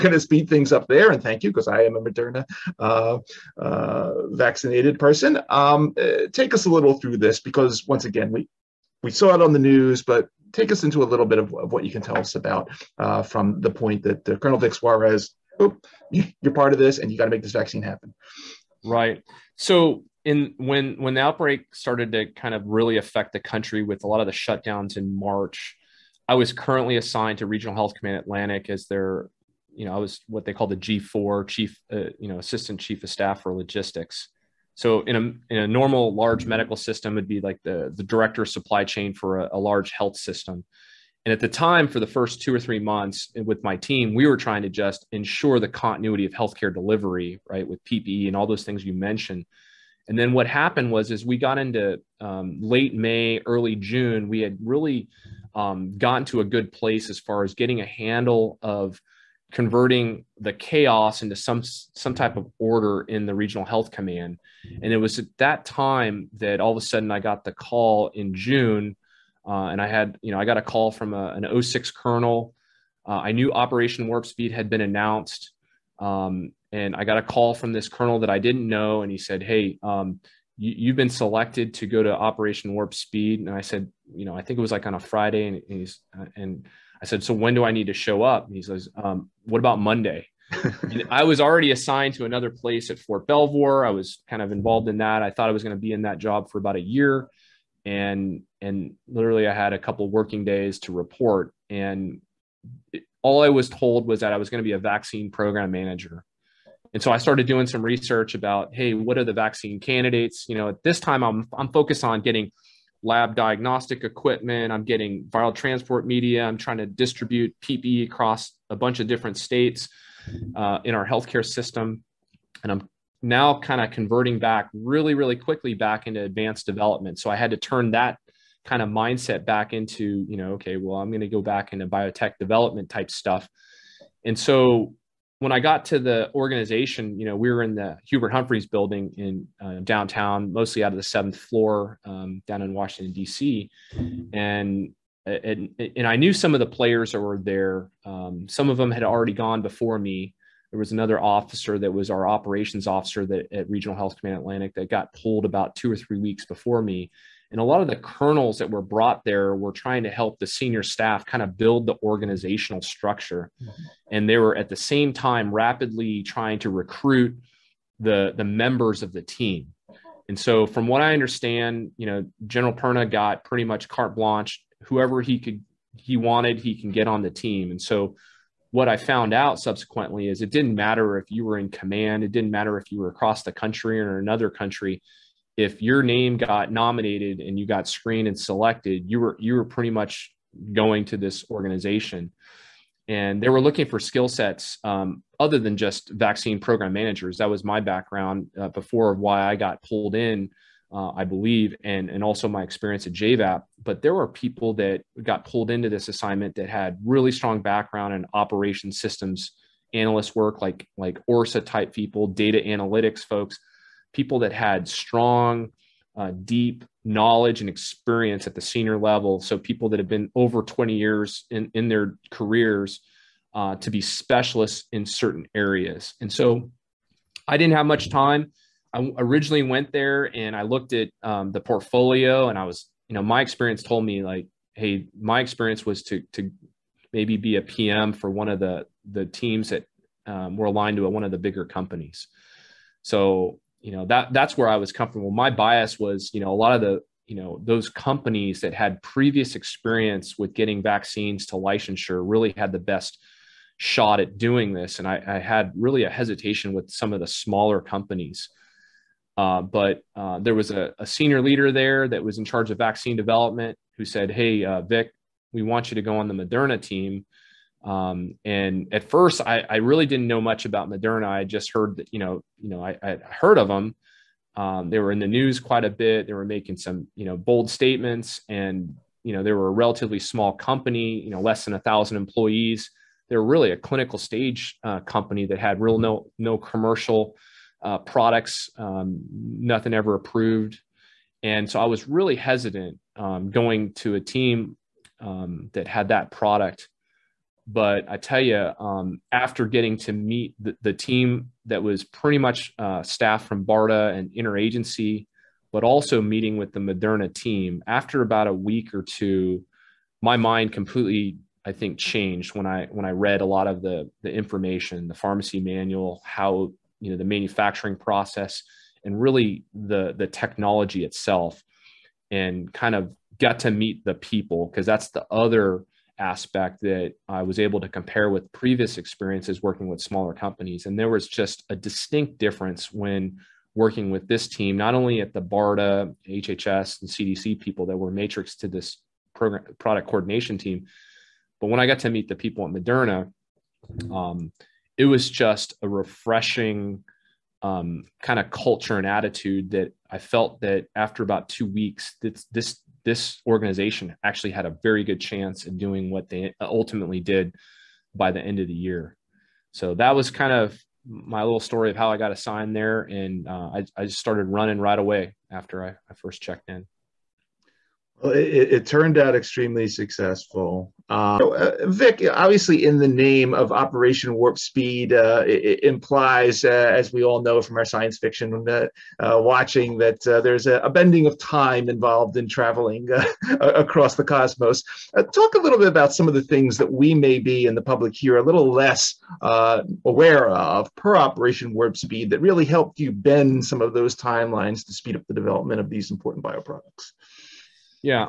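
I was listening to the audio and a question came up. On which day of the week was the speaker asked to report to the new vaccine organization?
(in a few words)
Monday.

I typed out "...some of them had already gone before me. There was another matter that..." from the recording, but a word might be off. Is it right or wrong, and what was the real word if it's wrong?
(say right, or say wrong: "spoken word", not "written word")
wrong: "officer", not "matter".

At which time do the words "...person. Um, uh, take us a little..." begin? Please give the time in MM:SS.
00:04.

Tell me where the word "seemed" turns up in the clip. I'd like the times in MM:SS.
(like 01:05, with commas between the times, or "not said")
not said.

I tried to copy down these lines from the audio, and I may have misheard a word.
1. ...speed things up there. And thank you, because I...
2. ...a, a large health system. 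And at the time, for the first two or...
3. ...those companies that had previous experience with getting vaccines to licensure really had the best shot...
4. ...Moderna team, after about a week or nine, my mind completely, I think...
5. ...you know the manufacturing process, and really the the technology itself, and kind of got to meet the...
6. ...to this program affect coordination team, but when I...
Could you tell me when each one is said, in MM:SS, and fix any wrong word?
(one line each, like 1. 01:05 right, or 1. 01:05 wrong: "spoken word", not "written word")
1. 00:00 right
2. 00:39 right
3. 04:07 right
4. 05:06 wrong: "two", not "nine"
5. 05:17 right
6. 05:38 wrong: "product", not "affect".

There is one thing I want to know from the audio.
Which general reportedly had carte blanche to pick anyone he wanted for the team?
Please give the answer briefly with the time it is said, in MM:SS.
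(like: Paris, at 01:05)
General Perna, at 02:52.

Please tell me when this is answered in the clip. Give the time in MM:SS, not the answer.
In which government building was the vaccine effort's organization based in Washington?
02:18.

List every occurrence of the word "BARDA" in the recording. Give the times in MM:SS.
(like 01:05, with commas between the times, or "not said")
05:03, 05:35.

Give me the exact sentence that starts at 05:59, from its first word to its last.
So that was kind of my little story of how I got assigned there.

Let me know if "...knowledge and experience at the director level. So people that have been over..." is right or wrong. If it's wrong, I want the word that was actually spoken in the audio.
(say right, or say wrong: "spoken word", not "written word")
wrong: "senior", not "director".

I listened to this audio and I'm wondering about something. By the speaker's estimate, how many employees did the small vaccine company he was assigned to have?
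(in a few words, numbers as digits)
less than 1,000.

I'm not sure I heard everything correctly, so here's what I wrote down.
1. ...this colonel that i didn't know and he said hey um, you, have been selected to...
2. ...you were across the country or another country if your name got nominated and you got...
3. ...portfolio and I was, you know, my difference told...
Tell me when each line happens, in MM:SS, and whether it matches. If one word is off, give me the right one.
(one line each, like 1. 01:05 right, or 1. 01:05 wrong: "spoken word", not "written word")
1. 01:17 right
2. 03:02 right
3. 03:51 wrong: "experience", not "difference".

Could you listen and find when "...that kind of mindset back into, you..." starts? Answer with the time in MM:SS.
02:07.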